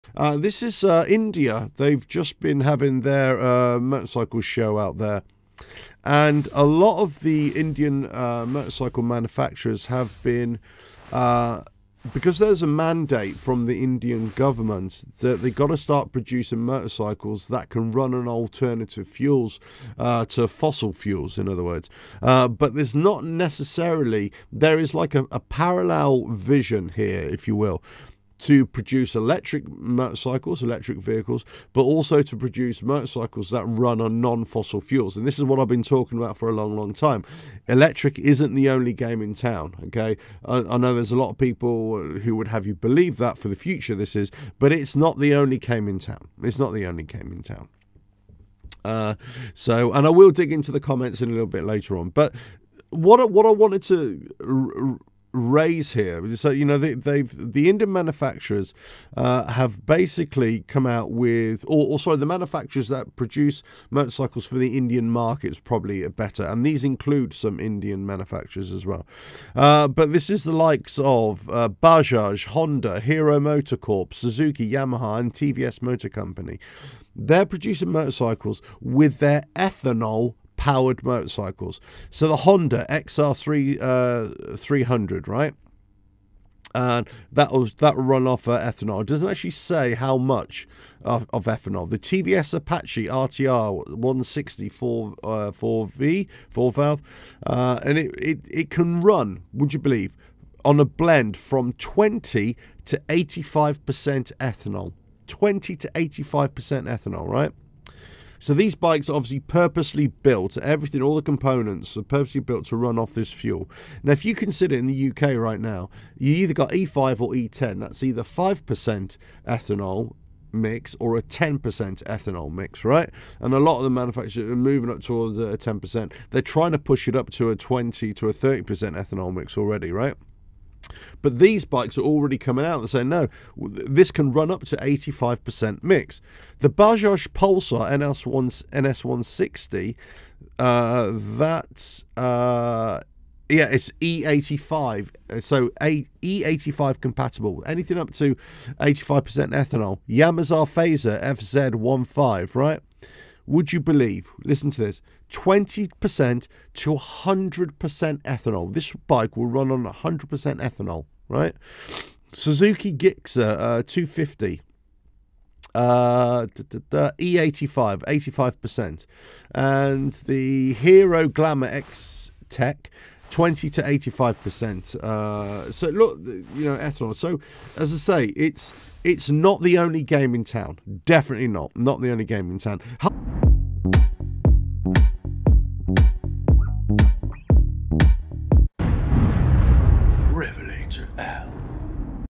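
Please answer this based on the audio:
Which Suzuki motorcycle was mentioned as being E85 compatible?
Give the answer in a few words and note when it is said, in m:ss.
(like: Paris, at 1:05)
Gixxer 250, at 2:42.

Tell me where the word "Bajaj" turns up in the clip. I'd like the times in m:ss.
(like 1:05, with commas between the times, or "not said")
1:11, 2:16.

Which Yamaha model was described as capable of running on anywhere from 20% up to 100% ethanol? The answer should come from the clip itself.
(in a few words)
Phaser FZ15.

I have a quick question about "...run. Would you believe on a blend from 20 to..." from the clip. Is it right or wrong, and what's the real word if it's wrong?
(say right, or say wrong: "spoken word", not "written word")
right.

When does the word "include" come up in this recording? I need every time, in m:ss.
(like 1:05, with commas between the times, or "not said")
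1:06.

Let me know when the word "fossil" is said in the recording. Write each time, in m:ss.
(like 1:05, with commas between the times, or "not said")
0:20, 0:34.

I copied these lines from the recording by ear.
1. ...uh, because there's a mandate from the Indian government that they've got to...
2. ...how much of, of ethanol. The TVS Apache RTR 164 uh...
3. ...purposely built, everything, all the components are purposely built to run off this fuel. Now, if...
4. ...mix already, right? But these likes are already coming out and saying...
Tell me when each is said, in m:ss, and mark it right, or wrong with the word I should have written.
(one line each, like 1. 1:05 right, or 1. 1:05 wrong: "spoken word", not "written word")
1. 0:11 right
2. 1:29 right
3. 1:49 right
4. 2:09 wrong: "bikes", not "likes".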